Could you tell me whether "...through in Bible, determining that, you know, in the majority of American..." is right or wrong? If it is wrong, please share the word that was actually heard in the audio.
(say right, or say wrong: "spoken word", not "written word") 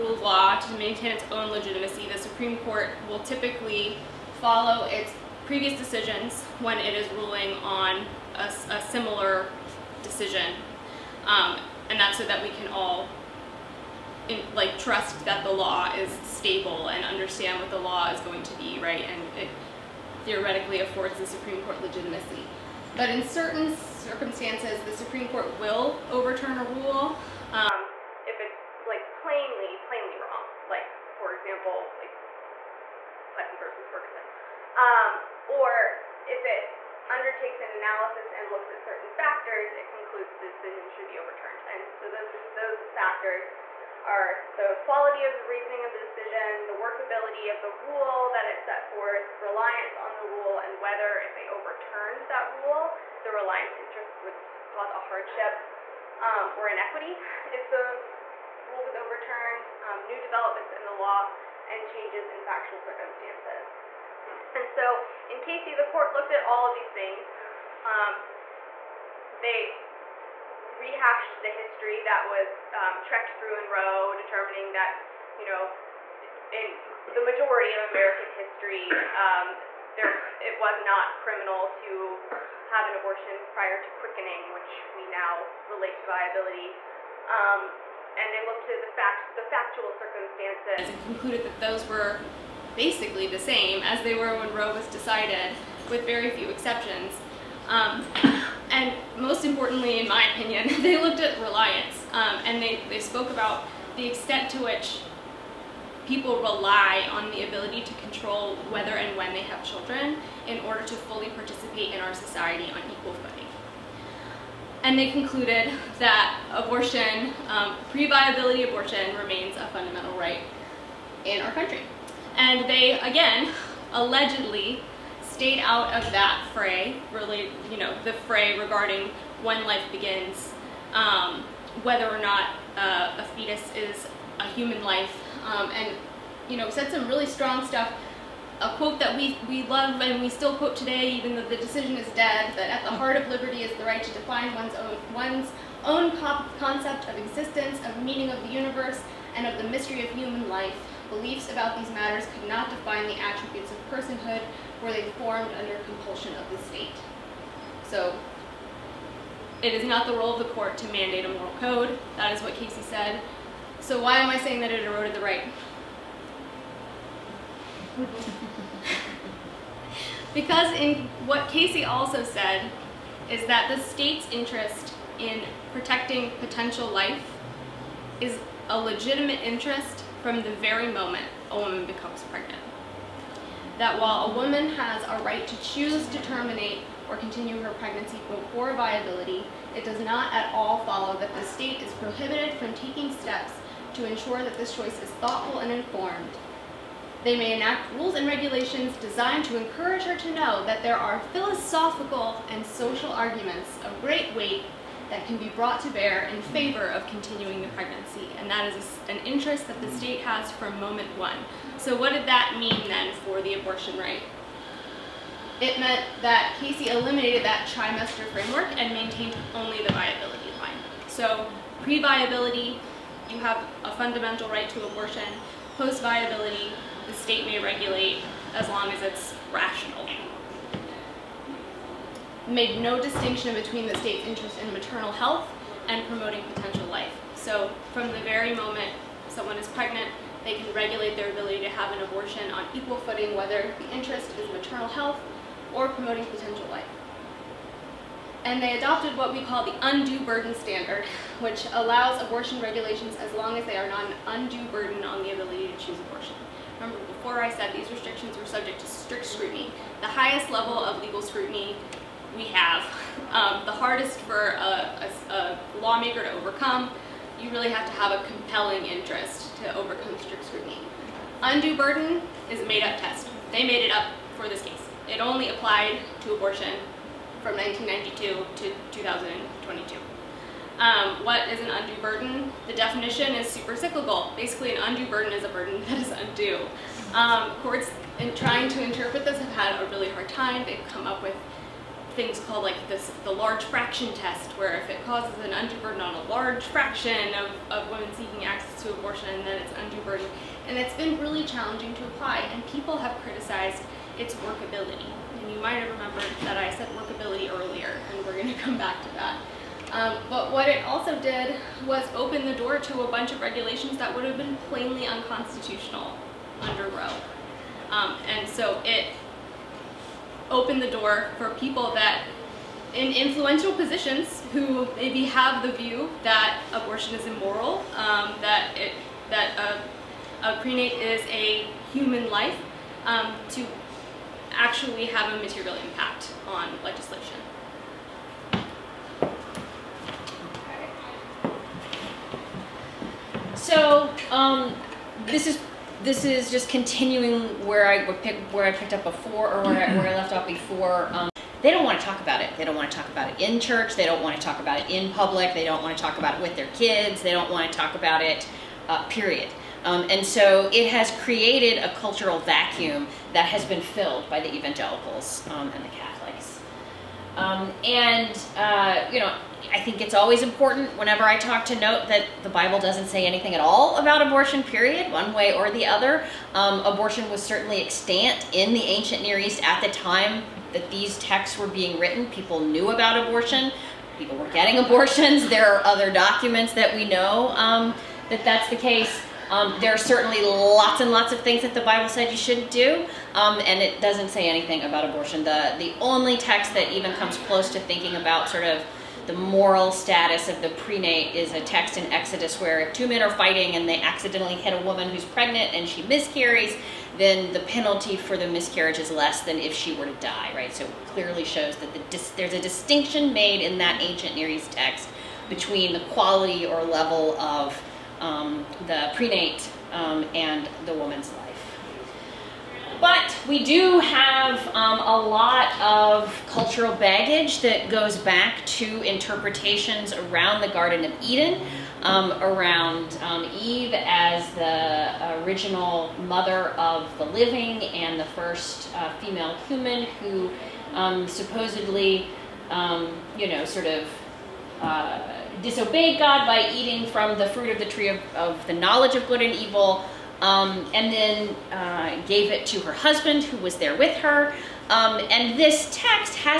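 wrong: "Roe", not "Bible".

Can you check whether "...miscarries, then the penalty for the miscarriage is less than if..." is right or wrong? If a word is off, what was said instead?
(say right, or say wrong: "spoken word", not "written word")
right.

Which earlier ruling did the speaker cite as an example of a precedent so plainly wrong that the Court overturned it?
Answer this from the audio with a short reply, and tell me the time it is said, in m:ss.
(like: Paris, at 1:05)
Plessy versus Ferguson, at 0:33.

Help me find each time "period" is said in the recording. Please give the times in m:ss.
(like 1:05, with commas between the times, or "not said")
5:59, 6:14.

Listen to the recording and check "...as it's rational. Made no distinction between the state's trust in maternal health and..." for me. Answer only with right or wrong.
wrong.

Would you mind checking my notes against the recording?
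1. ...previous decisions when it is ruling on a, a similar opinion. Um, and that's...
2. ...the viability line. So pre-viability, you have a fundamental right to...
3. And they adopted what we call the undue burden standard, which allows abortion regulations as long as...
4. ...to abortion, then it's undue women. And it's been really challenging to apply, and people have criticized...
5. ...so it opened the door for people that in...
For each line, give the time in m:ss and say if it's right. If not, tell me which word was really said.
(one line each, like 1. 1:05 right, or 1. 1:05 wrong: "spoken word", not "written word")
1. 0:05 wrong: "decision", not "opinion"
2. 3:39 right
3. 4:08 right
4. 4:58 wrong: "burden", not "women"
5. 5:18 right.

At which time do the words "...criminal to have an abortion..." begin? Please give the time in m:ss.
1:21.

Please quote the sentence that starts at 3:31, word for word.
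So what did that mean then for the abortion right?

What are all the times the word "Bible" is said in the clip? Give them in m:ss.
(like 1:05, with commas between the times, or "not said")
6:12, 6:31.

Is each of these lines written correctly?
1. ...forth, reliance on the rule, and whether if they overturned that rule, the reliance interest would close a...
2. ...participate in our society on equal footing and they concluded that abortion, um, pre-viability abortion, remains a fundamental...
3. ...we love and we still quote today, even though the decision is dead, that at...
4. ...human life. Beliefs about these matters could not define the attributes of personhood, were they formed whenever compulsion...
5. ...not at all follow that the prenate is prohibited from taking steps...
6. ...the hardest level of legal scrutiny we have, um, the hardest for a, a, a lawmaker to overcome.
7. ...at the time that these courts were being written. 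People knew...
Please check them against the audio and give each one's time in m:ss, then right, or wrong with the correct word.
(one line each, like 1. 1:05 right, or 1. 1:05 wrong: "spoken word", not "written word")
1. 0:48 wrong: "cause", not "close"
2. 1:51 right
3. 2:19 right
4. 2:30 wrong: "under", not "whenever"
5. 3:10 wrong: "state", not "prenate"
6. 4:19 wrong: "highest", not "hardest"
7. 6:19 wrong: "texts", not "courts".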